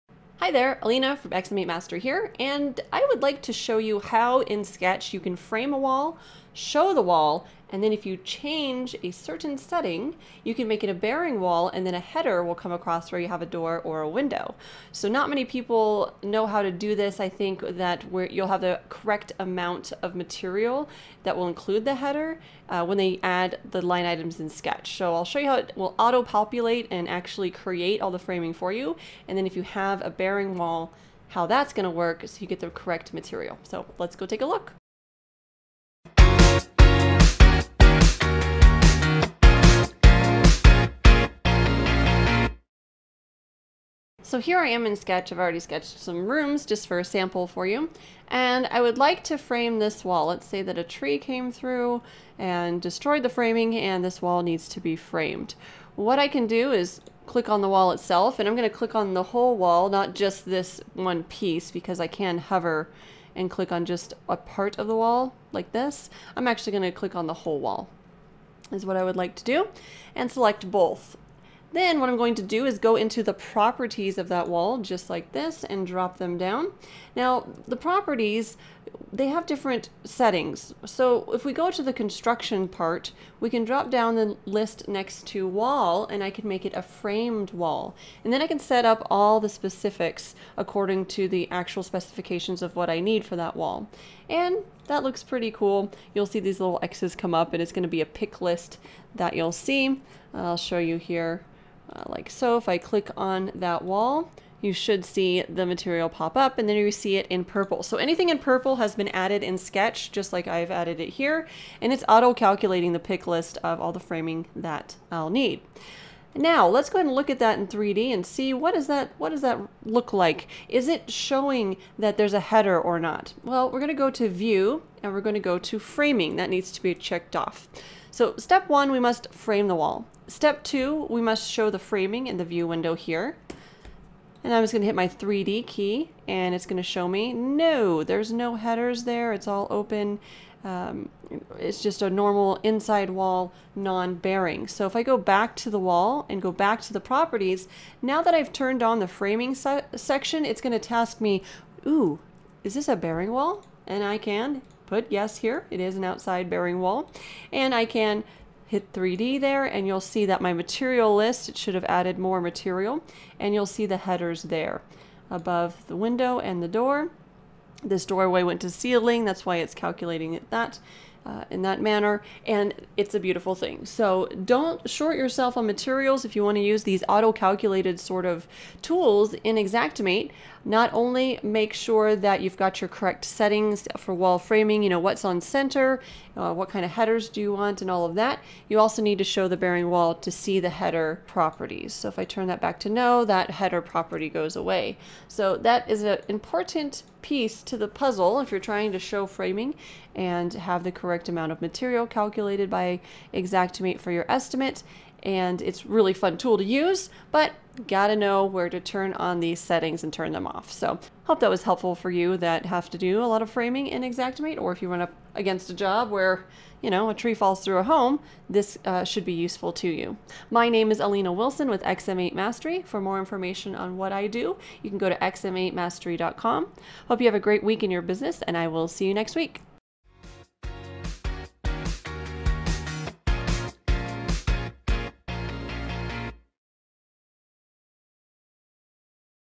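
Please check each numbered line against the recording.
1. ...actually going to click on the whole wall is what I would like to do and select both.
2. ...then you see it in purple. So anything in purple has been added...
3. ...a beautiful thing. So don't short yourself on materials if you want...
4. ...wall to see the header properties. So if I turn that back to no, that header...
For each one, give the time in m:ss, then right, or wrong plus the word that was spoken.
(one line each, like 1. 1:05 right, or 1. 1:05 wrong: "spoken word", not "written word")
1. 1:06 right
2. 1:46 right
3. 2:53 right
4. 3:09 right.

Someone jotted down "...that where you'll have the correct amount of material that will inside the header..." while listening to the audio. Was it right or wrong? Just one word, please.
wrong.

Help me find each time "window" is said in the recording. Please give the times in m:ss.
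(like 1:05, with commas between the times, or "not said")
0:14, 2:12, 2:45.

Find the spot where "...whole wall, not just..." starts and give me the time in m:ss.
0:59.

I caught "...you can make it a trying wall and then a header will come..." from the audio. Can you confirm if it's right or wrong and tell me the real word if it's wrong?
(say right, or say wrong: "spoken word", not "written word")
wrong: "bearing", not "trying".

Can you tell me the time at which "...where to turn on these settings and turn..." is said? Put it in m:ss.
3:28.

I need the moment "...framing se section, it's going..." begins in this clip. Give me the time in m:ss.
2:29.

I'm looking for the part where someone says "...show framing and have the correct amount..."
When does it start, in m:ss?
3:18.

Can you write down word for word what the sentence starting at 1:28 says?
And then I can set up all the specifics according to the actual specifications of what I need for that wall.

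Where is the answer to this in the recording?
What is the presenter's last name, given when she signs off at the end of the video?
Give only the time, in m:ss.
3:41.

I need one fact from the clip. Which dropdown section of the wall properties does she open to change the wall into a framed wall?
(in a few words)
Construction.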